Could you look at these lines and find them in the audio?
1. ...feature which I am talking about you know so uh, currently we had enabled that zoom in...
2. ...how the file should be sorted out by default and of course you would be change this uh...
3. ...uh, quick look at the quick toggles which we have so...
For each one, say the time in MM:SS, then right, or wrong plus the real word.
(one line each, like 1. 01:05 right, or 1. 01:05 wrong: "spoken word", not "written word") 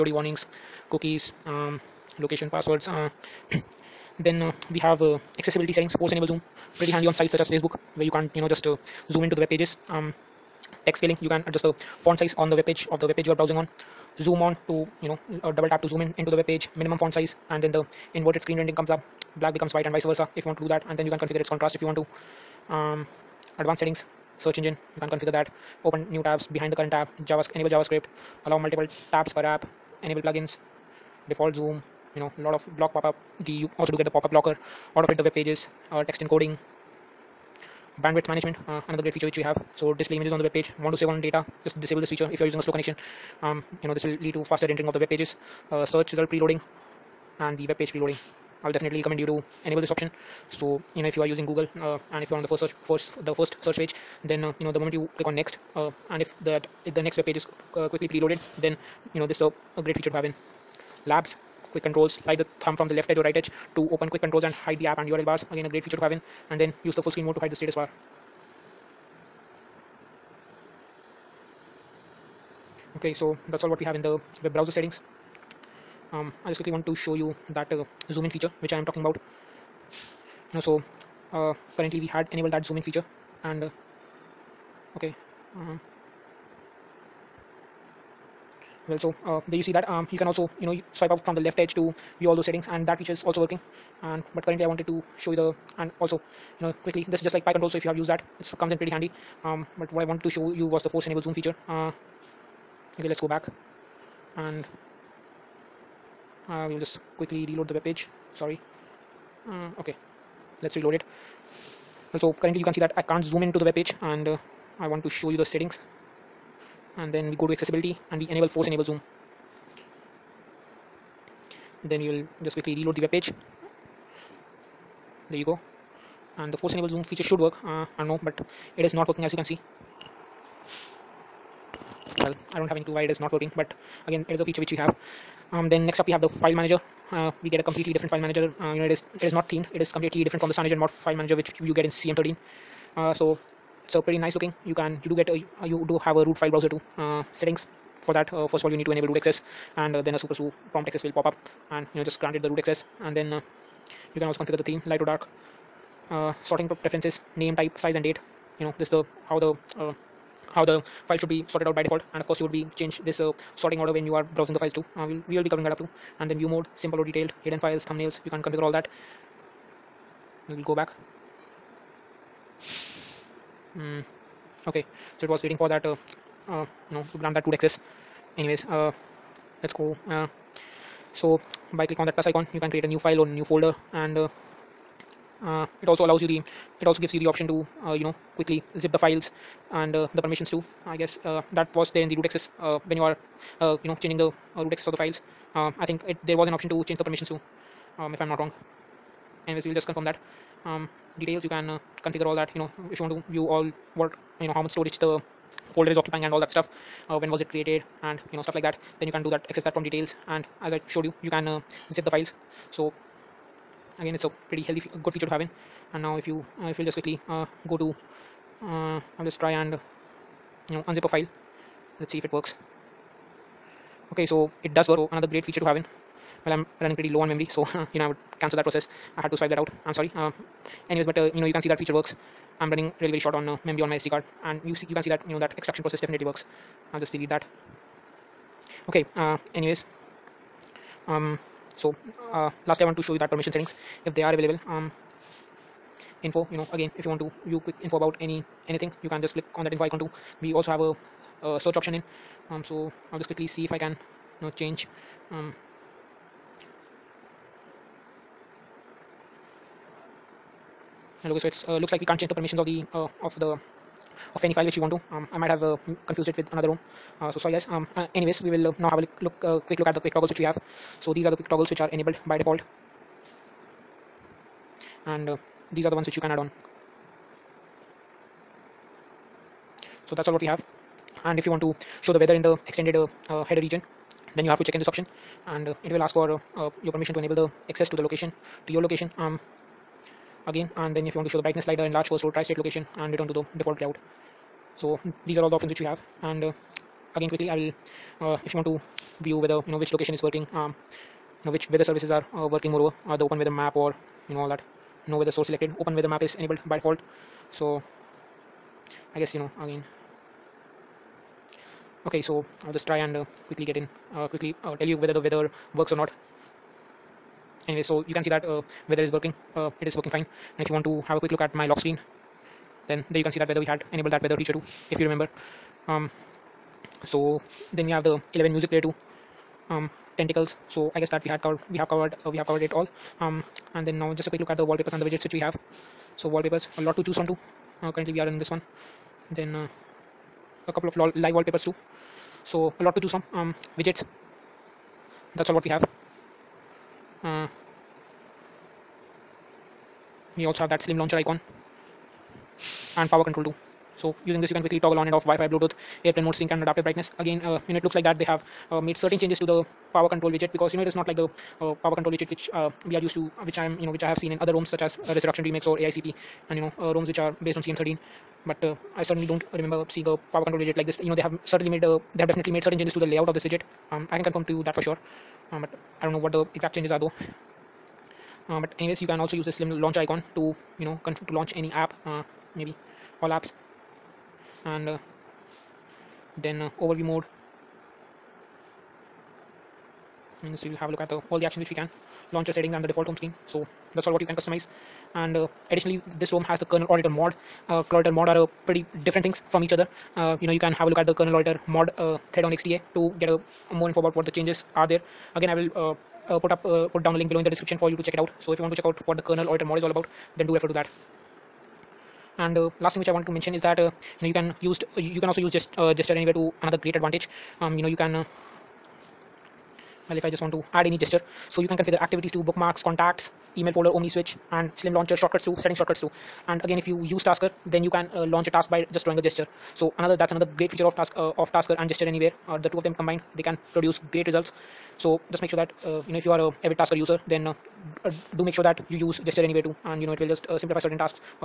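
1. 01:18 right
2. 02:40 right
3. 04:29 right.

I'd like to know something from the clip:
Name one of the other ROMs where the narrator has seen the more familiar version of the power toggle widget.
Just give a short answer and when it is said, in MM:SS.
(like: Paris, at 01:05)
Resurrection Remix, at 06:05.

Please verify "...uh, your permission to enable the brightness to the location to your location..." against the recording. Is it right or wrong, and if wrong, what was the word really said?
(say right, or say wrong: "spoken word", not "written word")
wrong: "access", not "brightness".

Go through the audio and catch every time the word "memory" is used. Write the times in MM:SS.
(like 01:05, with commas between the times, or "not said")
03:47, 03:53.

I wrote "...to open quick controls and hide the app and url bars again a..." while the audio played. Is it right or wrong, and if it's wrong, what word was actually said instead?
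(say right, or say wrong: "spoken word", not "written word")
right.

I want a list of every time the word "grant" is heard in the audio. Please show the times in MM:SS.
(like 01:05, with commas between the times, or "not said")
02:32, 02:57.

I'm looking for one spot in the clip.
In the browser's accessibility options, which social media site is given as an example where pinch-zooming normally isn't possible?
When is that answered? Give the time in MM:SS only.
00:07.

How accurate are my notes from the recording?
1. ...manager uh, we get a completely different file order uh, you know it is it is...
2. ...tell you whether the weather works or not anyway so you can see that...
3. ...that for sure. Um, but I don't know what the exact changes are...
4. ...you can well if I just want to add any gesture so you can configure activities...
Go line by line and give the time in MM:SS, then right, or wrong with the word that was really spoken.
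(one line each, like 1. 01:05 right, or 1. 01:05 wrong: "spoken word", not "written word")
1. 02:16 wrong: "manager", not "order"
2. 05:14 right
3. 06:14 right
4. 06:57 right.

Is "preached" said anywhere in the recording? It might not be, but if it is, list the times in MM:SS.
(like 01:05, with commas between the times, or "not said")
not said.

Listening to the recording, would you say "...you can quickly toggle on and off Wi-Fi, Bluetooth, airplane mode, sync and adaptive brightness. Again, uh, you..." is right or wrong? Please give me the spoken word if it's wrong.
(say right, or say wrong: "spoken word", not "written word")
right.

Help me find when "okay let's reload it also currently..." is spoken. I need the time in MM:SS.
01:49.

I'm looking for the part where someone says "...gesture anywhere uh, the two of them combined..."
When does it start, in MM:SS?
07:11.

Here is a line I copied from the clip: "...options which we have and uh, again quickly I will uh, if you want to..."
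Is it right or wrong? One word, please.
right.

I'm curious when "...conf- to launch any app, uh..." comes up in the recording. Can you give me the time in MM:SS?
06:21.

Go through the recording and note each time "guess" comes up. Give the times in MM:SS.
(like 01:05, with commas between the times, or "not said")
03:10, 05:09, 05:30.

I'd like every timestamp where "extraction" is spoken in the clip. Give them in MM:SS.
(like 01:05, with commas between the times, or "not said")
03:55.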